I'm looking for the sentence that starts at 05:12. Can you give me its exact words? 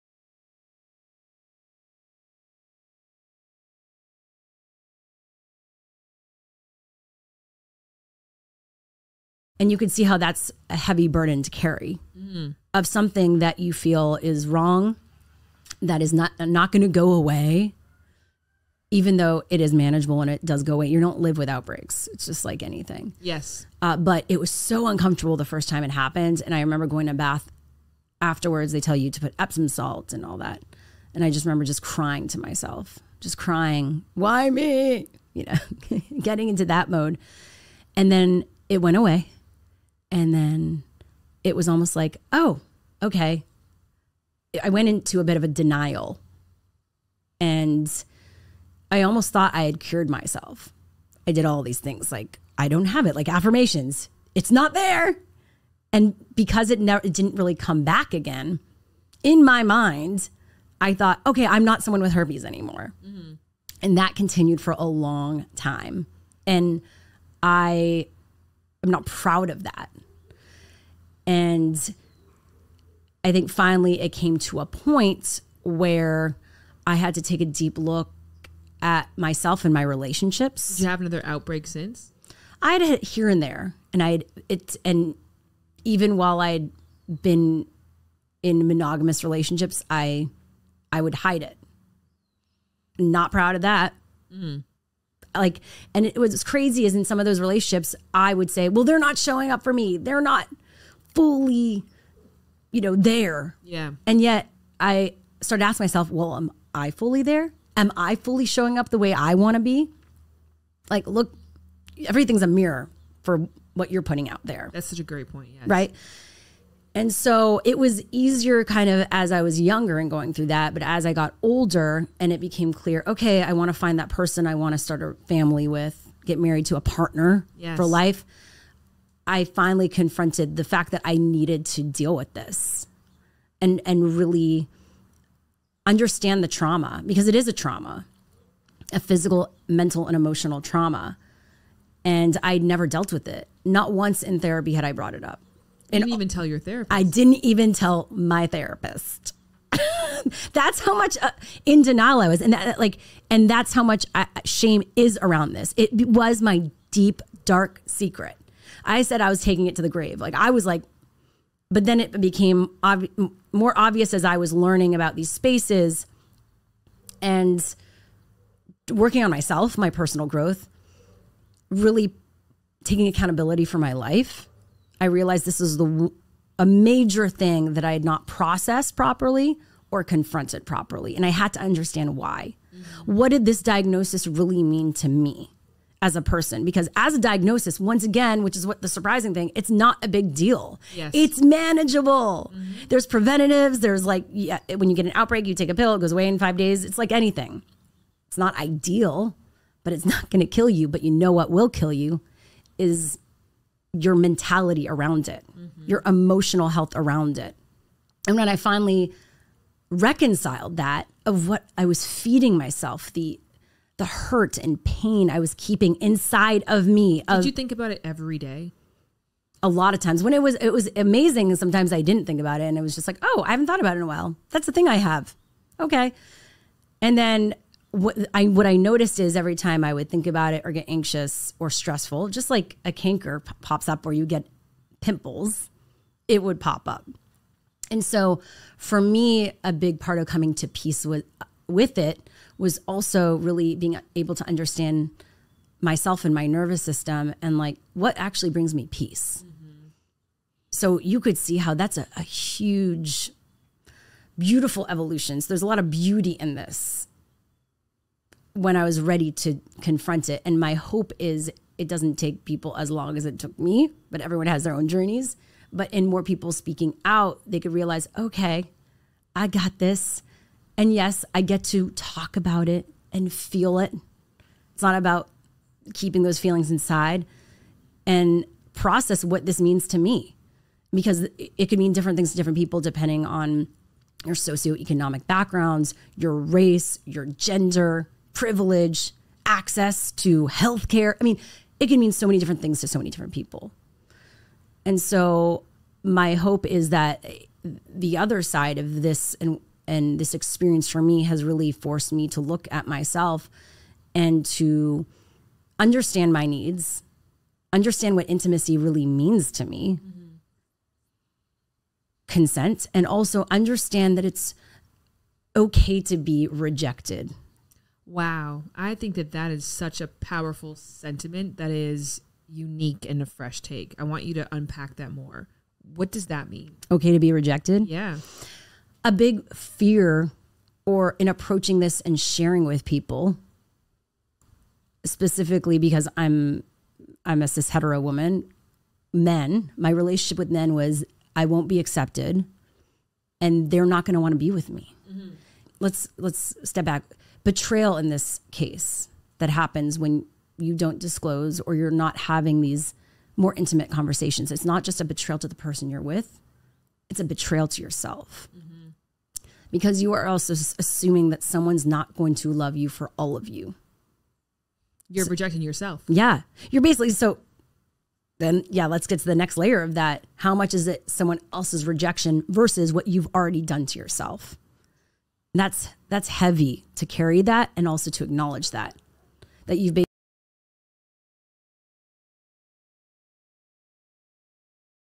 consent, and also understand that it's okay to be rejected.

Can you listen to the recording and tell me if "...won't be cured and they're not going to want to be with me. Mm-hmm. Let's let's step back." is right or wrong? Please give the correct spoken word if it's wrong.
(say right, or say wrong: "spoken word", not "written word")
wrong: "accepted", not "cured".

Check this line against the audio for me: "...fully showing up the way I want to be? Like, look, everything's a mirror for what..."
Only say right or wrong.
right.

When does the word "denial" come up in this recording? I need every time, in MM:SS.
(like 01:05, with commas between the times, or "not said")
00:45, 02:31.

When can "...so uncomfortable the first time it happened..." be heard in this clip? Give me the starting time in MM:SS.
00:24.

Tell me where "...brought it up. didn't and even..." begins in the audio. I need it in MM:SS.
02:24.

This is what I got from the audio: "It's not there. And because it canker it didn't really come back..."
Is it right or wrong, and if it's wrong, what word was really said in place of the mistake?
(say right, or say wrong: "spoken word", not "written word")
wrong: "never", not "canker".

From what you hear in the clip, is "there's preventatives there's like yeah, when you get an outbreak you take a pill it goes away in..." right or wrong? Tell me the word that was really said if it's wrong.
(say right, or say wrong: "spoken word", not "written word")
right.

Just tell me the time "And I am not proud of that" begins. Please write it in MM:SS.
01:06.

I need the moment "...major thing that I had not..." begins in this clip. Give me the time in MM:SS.
02:56.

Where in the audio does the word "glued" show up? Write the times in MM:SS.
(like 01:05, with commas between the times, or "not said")
not said.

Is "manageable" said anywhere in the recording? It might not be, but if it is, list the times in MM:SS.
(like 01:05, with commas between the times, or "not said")
00:19, 03:11.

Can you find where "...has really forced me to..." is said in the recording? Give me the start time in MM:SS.
05:01.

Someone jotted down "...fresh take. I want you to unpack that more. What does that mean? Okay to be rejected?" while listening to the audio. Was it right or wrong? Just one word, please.
right.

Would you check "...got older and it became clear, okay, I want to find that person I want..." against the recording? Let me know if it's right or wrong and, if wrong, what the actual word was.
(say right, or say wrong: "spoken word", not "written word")
right.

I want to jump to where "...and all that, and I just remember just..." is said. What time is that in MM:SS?
00:30.